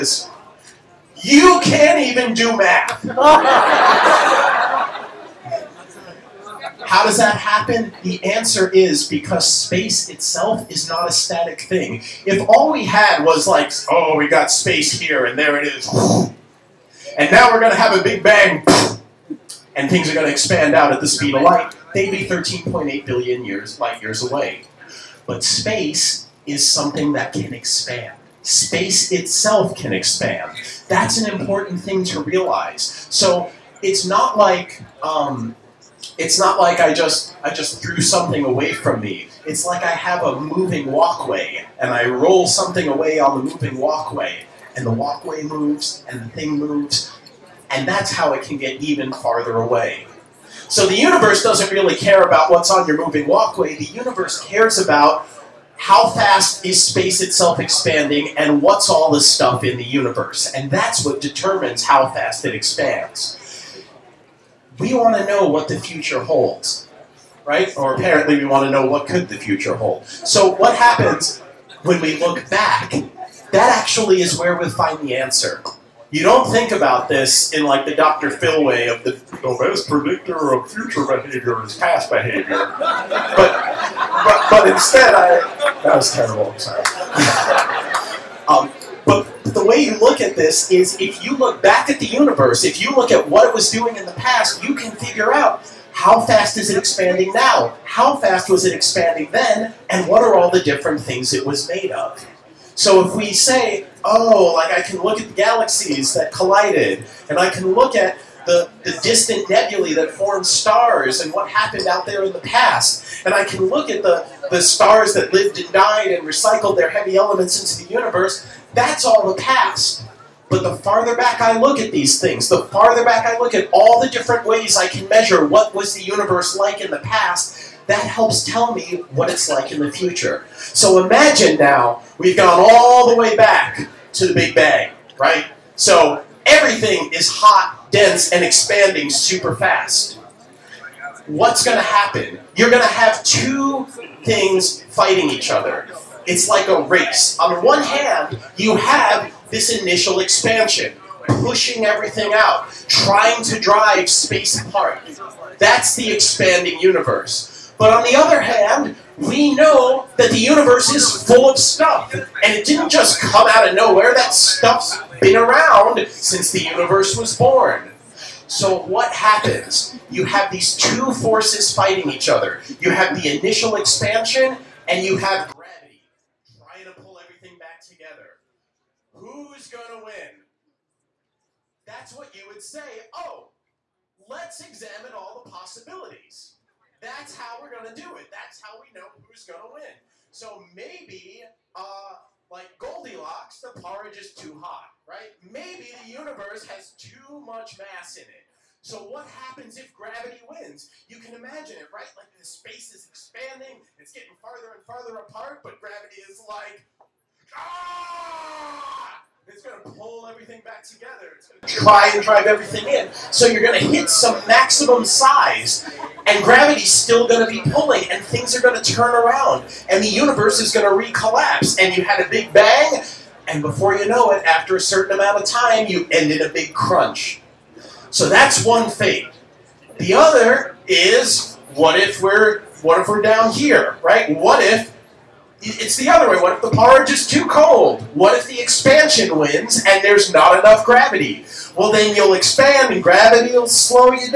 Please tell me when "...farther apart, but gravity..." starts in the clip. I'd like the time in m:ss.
3:24.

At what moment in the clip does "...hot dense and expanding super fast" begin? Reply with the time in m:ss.
2:17.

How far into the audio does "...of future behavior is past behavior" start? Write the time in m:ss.
1:20.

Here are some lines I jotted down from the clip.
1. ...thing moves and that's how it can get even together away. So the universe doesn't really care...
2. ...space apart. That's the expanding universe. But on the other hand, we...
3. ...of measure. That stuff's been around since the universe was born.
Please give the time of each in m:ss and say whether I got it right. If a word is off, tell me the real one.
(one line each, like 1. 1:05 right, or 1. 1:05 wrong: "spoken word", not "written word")
1. 0:46 wrong: "farther", not "together"
2. 2:34 right
3. 2:43 wrong: "nowhere", not "measure".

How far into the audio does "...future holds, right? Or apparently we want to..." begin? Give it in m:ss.
1:05.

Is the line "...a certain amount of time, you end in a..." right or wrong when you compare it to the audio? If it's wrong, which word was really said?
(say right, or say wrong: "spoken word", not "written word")
right.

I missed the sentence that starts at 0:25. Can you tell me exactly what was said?
But space is something that can expand.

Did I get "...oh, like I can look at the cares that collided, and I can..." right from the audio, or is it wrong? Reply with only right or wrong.
wrong.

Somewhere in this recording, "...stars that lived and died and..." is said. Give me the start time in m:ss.
1:54.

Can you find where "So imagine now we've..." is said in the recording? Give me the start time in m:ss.
2:10.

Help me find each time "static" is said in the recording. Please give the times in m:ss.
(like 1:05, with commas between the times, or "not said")
0:11.